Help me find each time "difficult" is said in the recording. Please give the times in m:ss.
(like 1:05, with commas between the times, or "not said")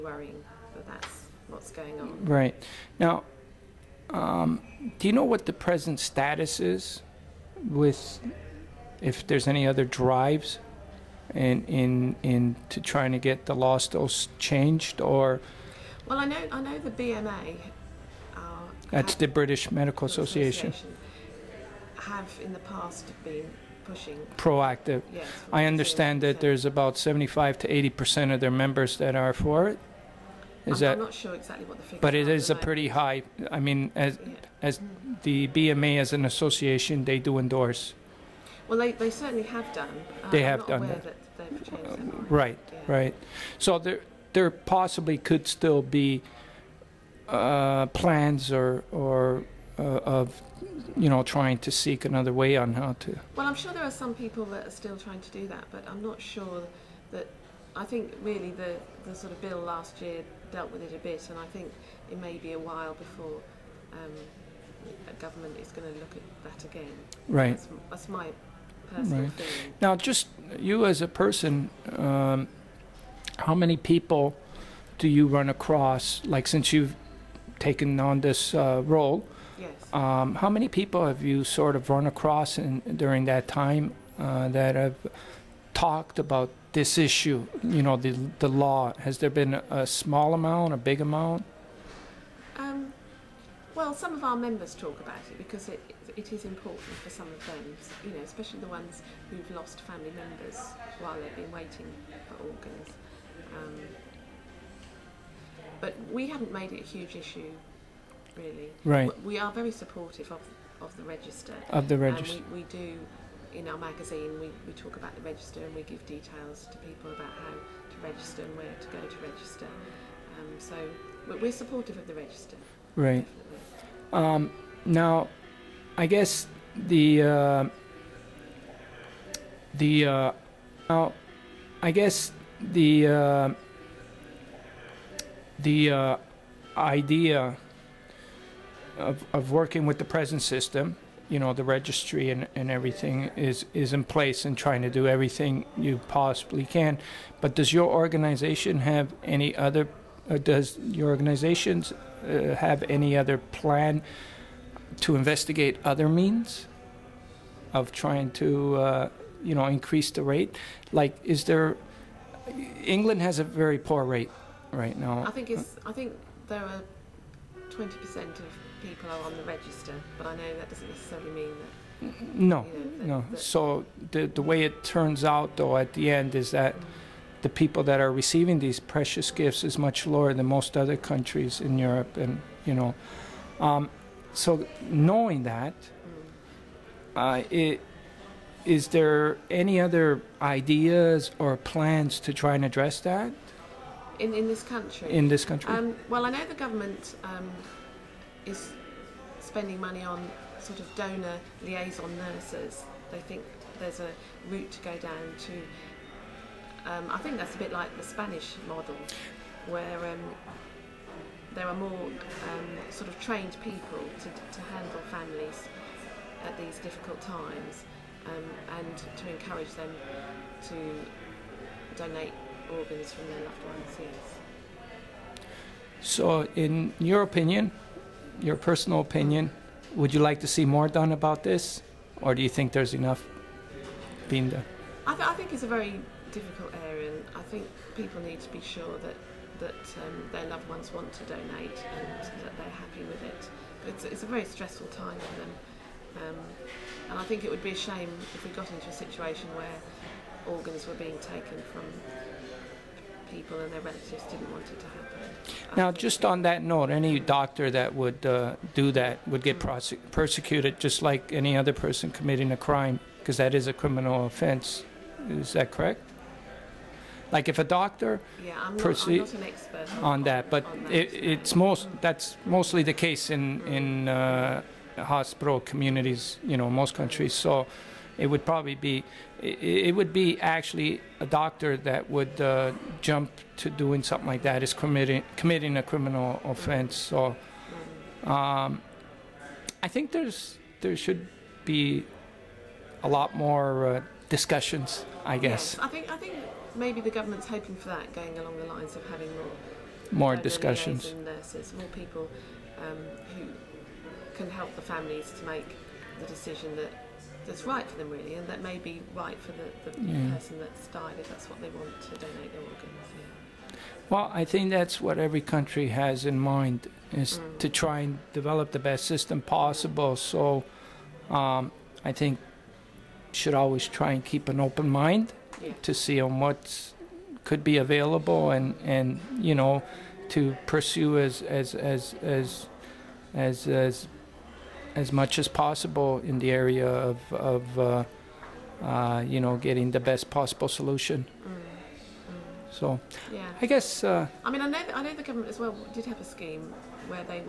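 3:36, 3:56.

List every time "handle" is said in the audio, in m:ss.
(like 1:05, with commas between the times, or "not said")
3:34.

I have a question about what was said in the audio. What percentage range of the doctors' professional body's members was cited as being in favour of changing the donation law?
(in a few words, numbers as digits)
75 to 80 percent.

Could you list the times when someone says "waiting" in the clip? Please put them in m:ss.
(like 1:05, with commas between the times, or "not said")
1:41.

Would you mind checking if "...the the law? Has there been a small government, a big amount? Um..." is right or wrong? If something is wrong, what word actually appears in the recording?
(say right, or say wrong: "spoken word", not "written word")
wrong: "amount", not "government".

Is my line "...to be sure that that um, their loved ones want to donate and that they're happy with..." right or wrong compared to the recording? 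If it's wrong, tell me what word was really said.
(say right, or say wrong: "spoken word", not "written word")
right.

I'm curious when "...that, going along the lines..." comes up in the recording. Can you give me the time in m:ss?
4:57.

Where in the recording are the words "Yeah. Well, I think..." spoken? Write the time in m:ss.
5:13.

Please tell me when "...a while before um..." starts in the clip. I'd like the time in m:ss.
1:02.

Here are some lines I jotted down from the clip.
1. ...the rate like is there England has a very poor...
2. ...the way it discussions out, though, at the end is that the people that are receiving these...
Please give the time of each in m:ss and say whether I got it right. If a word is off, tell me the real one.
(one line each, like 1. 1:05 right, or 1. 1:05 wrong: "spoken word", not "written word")
1. 2:40 right
2. 2:54 wrong: "turns", not "discussions".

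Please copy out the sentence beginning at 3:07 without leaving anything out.
uh, it, is there any other ideas or plans to try and address that?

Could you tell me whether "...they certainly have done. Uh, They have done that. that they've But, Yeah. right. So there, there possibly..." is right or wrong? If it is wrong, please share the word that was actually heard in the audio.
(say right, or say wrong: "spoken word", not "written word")
wrong: "Right", not "But".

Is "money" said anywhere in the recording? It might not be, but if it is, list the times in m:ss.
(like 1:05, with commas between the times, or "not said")
3:19.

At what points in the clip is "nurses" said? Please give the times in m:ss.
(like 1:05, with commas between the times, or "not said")
3:22, 5:01.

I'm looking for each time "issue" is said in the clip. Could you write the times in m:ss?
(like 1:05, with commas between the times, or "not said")
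1:26, 1:47.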